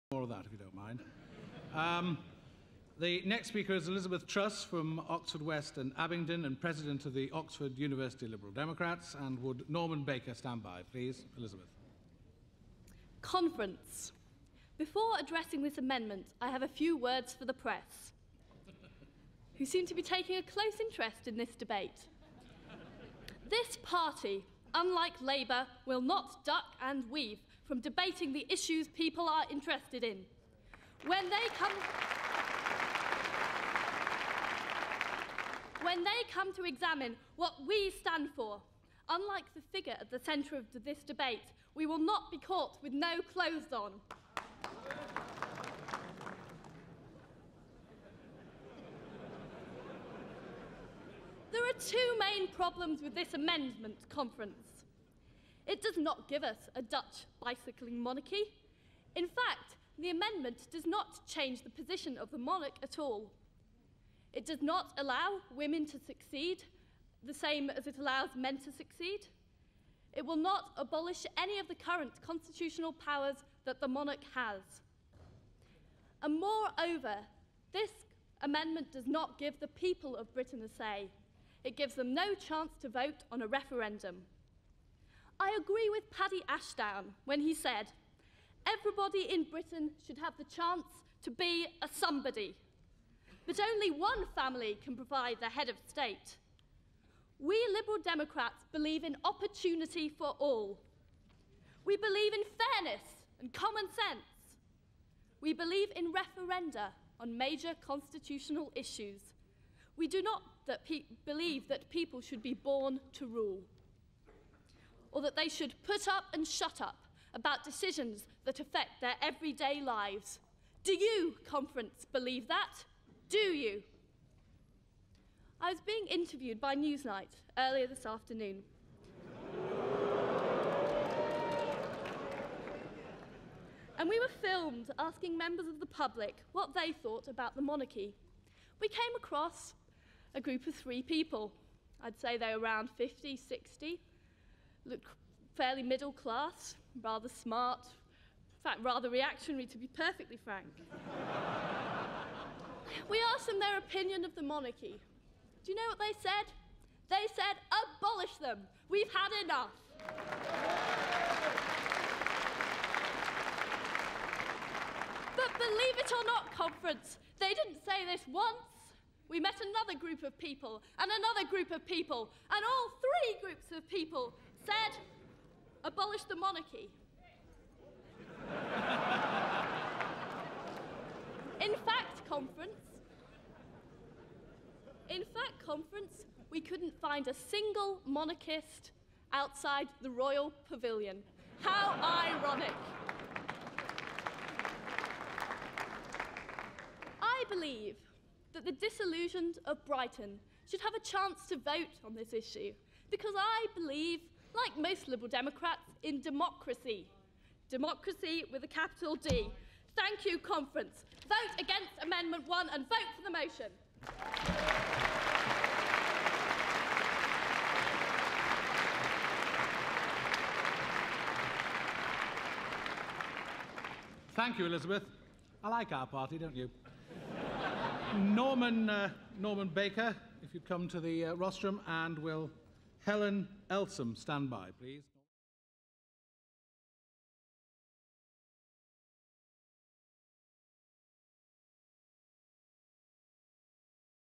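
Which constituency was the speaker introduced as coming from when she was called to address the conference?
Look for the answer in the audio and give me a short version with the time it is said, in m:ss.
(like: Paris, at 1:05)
Oxford West and Abingdon, at 0:05.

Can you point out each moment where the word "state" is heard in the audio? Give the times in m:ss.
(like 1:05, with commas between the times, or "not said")
1:35.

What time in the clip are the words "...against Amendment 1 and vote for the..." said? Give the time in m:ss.
3:31.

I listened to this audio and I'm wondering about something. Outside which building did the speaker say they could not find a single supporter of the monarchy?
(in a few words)
Royal Pavilion.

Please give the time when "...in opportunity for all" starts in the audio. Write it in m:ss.
1:39.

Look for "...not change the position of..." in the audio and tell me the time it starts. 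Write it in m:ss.
1:00.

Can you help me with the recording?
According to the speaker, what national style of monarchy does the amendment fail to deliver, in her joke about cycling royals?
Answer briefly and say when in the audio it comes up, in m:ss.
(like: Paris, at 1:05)
Dutch, at 0:56.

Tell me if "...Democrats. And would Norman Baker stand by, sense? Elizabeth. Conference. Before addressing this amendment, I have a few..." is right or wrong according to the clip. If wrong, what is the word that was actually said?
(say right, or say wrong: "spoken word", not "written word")
wrong: "please", not "sense".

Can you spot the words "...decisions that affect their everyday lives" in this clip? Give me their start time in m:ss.
1:57.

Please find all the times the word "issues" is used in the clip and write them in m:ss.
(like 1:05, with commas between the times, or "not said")
0:28, 1:48, 3:22.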